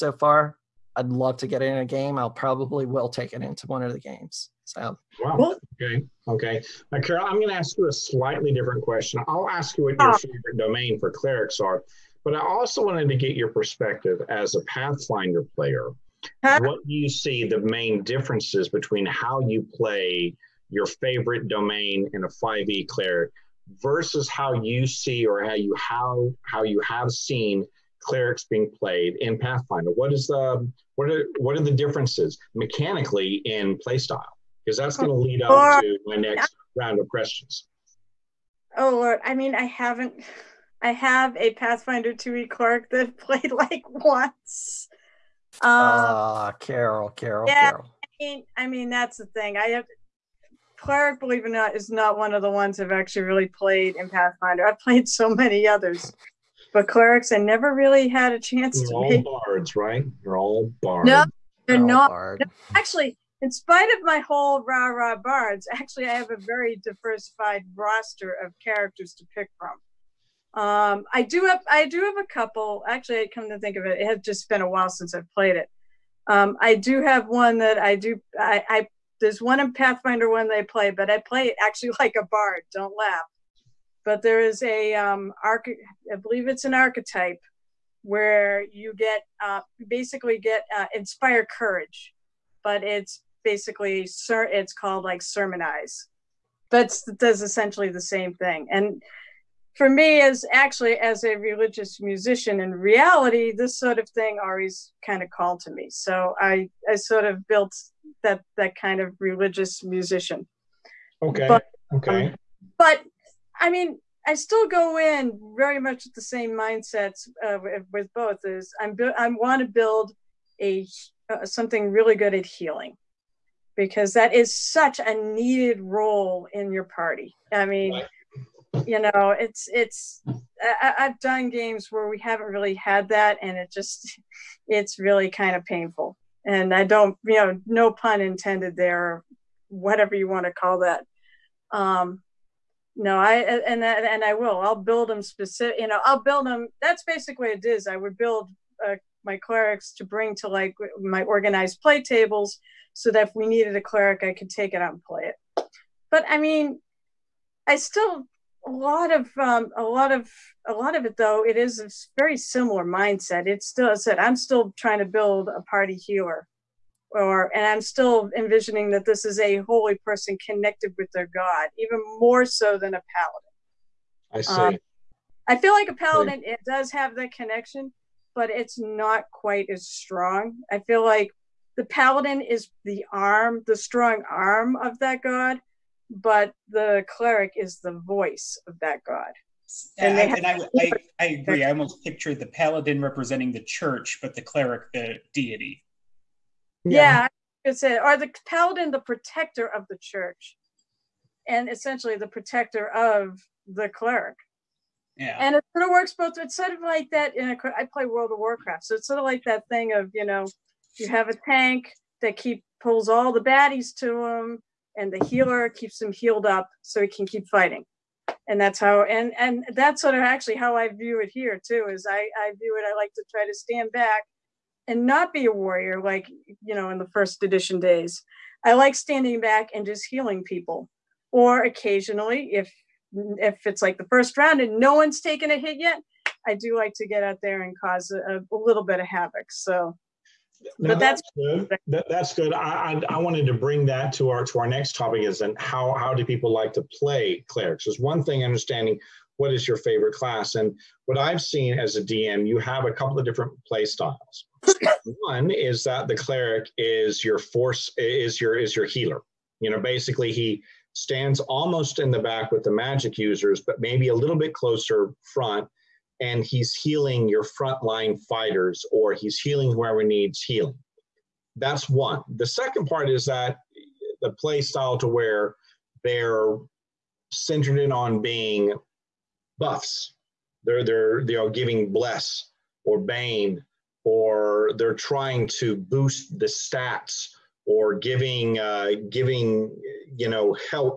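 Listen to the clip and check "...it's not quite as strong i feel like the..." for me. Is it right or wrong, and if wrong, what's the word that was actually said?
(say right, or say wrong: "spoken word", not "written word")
right.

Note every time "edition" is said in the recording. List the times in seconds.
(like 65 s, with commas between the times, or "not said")
227 s.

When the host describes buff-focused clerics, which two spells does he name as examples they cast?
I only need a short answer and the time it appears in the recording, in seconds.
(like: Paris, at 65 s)
Bless or bane, at 281 s.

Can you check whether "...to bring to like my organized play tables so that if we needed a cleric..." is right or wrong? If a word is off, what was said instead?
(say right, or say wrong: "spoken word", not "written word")
right.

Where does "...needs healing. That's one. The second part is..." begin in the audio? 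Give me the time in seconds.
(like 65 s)
270 s.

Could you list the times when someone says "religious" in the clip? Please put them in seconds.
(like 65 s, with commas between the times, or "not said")
101 s, 109 s.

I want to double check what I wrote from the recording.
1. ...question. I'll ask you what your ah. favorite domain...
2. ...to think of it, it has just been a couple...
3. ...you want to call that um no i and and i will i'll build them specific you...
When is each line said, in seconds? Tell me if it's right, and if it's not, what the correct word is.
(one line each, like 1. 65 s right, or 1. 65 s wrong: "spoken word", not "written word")
1. 8 s right
2. 73 s wrong: "while", not "couple"
3. 140 s right.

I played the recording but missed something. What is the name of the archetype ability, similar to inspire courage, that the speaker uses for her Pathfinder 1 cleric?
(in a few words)
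Sermonize.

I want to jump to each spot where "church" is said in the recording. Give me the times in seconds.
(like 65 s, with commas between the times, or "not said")
193 s, 200 s.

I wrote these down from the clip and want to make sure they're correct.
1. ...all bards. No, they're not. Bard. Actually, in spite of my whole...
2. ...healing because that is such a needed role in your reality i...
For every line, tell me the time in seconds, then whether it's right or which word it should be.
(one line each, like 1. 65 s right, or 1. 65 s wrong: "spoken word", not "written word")
1. 60 s right
2. 122 s wrong: "party", not "reality".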